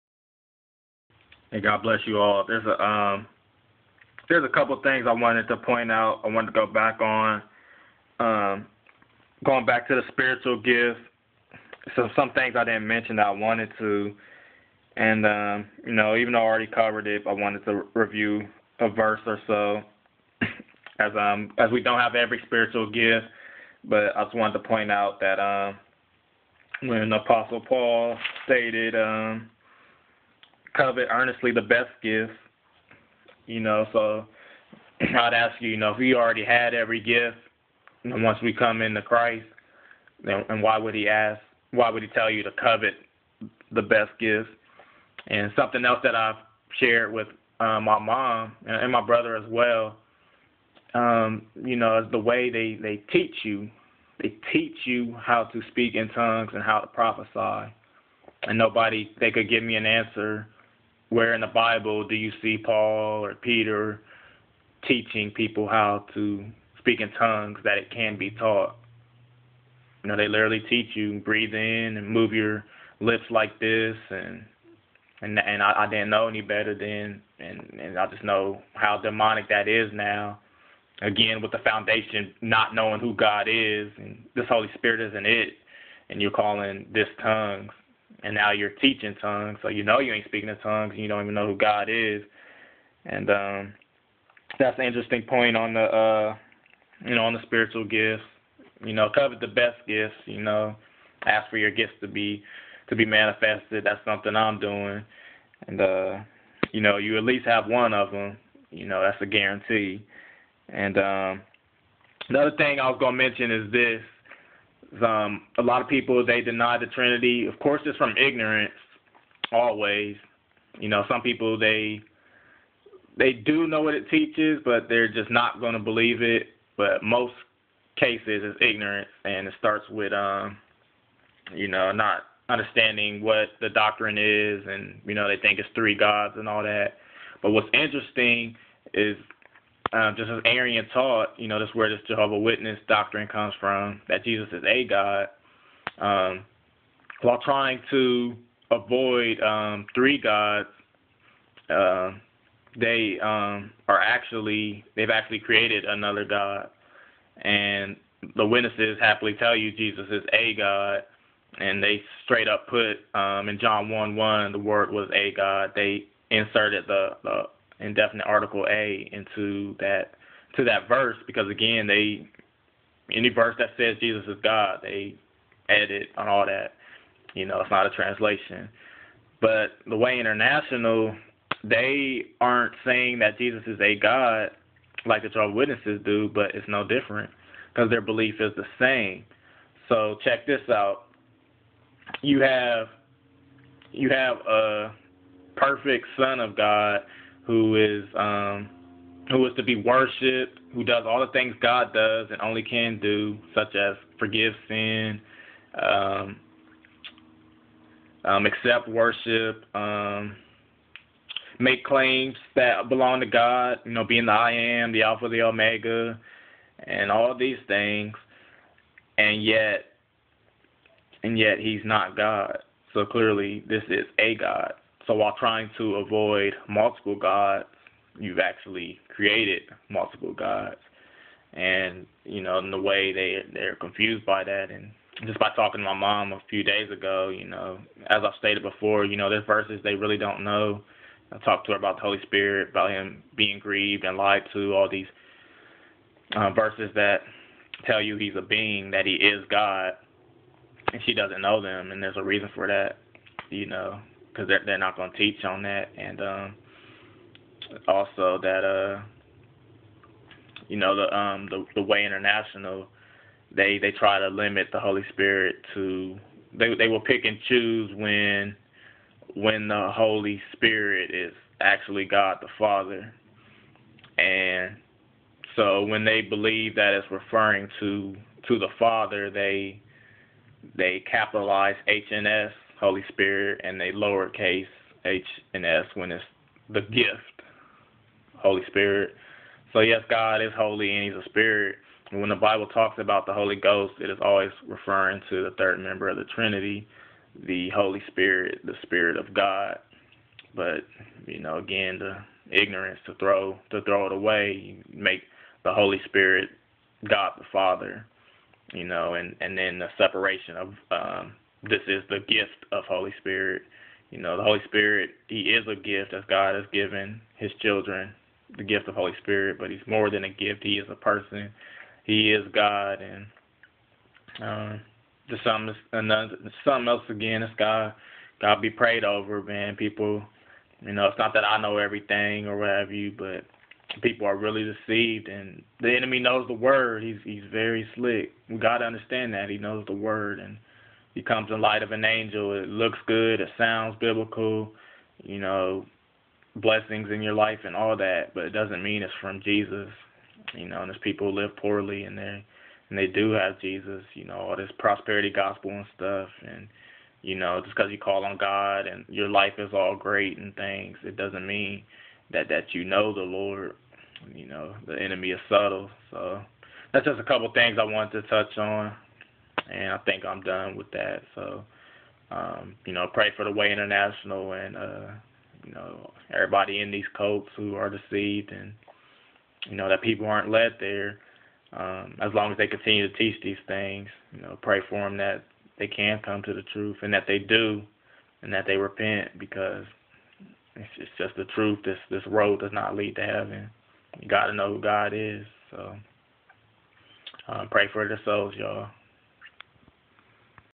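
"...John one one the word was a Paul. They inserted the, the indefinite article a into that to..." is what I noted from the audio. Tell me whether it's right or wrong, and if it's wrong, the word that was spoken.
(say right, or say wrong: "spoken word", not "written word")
wrong: "God", not "Paul".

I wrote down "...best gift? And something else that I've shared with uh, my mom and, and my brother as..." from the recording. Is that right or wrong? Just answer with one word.
right.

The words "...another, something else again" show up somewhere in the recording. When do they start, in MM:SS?
05:25.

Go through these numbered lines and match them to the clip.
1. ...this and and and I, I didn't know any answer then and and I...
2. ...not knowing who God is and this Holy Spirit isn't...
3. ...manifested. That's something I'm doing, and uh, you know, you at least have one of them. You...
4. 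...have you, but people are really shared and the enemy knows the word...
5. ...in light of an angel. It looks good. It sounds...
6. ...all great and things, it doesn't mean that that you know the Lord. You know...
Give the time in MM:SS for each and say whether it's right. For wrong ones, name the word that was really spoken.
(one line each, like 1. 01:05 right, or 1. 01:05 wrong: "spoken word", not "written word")
1. 01:13 wrong: "better", not "answer"
2. 01:22 right
3. 01:43 right
4. 05:32 wrong: "deceived", not "shared"
5. 05:41 right
6. 05:59 right.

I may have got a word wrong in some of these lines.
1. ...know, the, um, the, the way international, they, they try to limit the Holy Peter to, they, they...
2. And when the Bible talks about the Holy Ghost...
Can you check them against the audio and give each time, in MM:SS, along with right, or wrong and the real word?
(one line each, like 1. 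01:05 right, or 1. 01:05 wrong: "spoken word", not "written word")
1. 04:20 wrong: "Spirit", not "Peter"
2. 04:52 right.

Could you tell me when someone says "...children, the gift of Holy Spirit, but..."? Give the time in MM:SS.
05:17.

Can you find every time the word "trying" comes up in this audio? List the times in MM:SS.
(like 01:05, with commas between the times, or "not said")
02:27, 03:45.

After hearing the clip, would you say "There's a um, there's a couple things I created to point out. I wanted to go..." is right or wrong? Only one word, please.
wrong.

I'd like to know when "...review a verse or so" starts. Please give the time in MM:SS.
00:17.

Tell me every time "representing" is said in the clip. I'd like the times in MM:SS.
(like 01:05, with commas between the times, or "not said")
not said.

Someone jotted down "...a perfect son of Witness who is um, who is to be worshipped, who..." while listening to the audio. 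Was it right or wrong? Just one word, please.
wrong.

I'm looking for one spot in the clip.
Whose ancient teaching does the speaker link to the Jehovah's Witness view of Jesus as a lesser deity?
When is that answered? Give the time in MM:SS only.
02:20.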